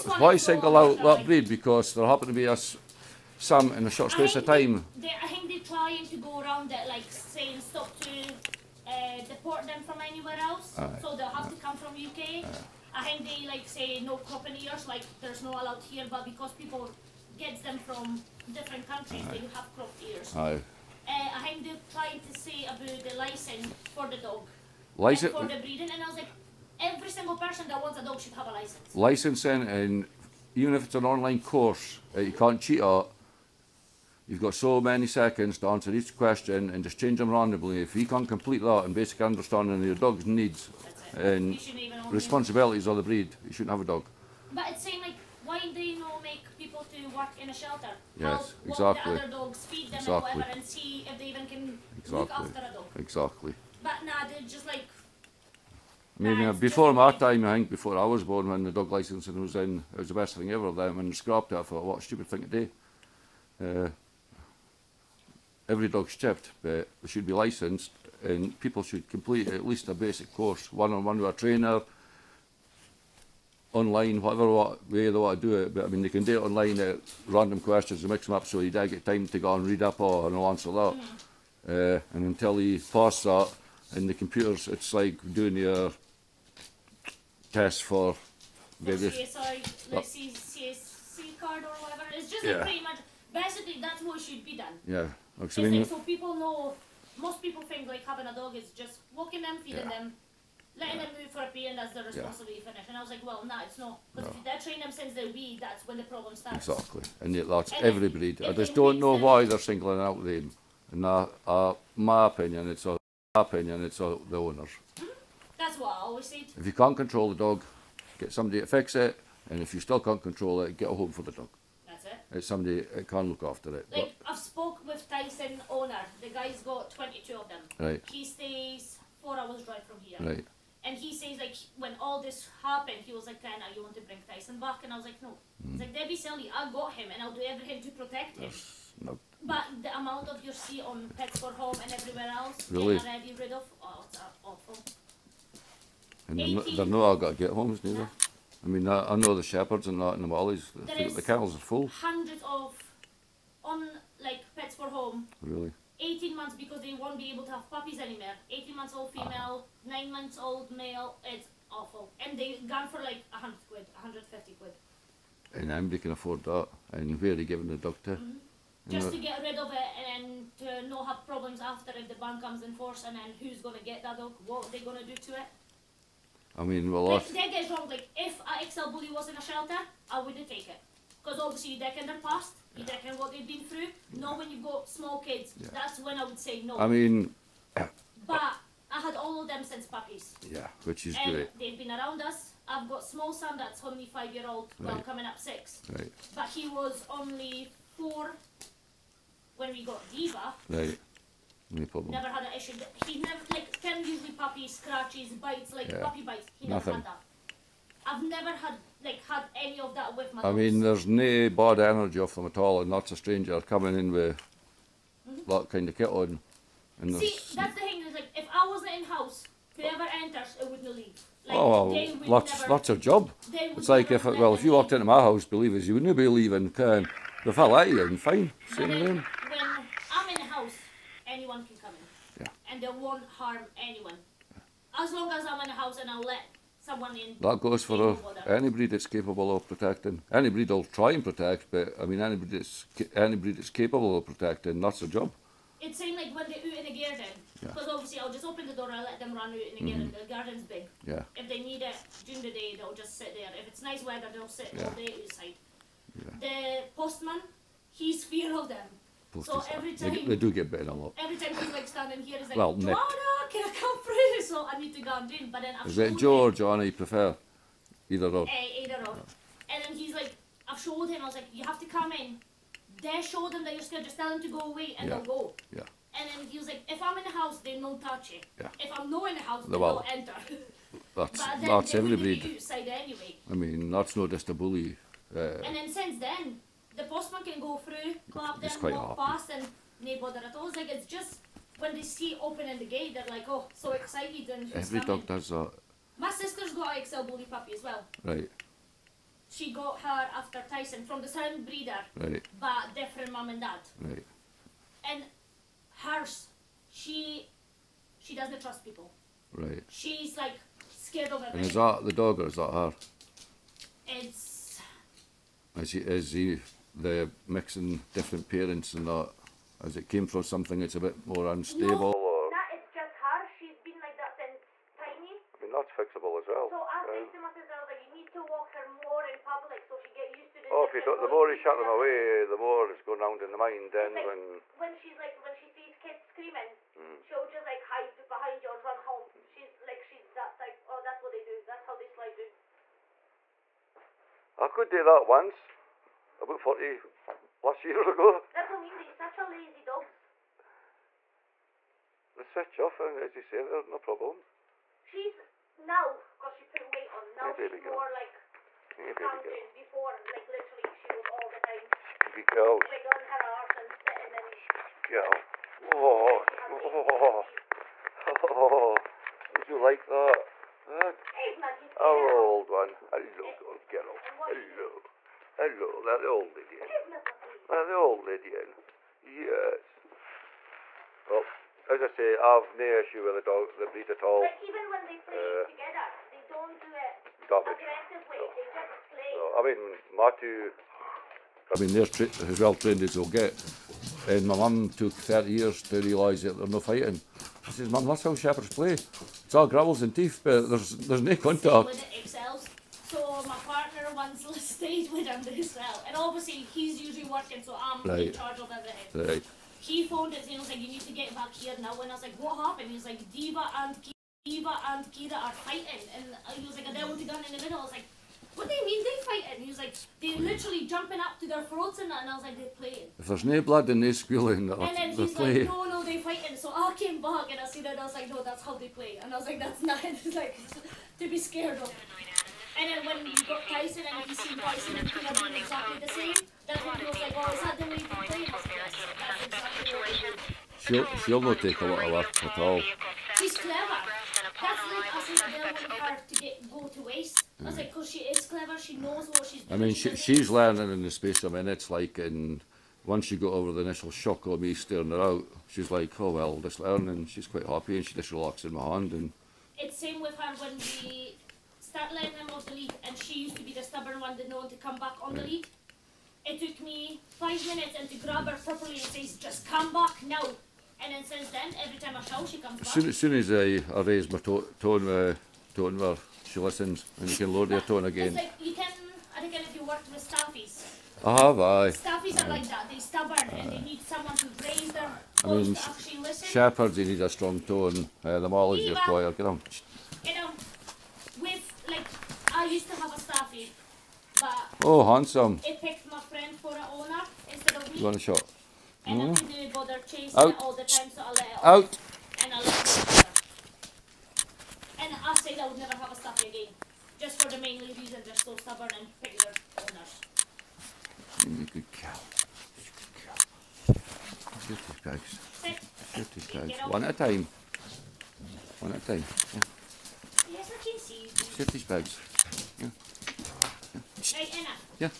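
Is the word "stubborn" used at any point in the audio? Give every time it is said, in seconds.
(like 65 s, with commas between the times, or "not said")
463 s, 483 s, 508 s.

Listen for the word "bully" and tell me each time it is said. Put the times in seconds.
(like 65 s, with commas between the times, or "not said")
178 s, 284 s, 297 s.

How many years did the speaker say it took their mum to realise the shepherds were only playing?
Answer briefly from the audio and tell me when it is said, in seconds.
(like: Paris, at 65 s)
30 years, at 395 s.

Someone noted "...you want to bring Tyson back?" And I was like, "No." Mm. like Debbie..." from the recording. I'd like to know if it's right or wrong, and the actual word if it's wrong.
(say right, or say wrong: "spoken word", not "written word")
right.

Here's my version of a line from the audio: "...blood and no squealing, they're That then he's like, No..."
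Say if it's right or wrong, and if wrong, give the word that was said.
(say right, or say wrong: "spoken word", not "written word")
wrong: "And", not "That".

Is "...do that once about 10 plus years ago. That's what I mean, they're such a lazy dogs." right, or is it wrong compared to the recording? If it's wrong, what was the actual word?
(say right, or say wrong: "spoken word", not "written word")
wrong: "40", not "10".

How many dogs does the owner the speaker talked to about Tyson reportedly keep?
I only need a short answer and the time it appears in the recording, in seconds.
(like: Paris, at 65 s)
22, at 126 s.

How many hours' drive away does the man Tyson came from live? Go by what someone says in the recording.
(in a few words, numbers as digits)
4 hours.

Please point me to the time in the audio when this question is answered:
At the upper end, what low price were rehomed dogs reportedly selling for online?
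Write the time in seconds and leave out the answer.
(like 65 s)
163 s.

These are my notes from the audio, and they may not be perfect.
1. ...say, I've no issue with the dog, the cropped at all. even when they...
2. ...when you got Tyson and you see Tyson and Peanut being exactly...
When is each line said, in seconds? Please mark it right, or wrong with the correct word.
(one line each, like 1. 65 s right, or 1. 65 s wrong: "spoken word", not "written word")
1. 382 s wrong: "breed", not "cropped"
2. 433 s right.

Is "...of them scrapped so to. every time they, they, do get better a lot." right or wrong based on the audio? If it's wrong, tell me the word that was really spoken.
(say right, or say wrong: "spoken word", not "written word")
wrong: "supposed", not "scrapped".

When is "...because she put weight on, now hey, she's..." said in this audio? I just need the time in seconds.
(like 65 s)
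356 s.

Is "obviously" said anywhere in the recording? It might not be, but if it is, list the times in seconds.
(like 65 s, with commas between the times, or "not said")
181 s, 247 s, 406 s.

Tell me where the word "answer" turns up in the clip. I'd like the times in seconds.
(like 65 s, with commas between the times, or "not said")
35 s, 80 s.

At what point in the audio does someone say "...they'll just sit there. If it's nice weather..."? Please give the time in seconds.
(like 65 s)
252 s.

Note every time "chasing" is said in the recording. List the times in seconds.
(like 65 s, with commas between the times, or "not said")
500 s.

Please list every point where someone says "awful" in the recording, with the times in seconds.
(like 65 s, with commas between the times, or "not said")
144 s, 161 s.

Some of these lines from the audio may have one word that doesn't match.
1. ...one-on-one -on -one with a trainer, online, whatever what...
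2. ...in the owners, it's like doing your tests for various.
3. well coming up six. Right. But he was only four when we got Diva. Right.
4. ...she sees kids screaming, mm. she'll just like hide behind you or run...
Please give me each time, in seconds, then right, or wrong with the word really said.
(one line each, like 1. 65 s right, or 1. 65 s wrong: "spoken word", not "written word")
1. 70 s right
2. 83 s wrong: "computers", not "owners"
3. 194 s right
4. 335 s right.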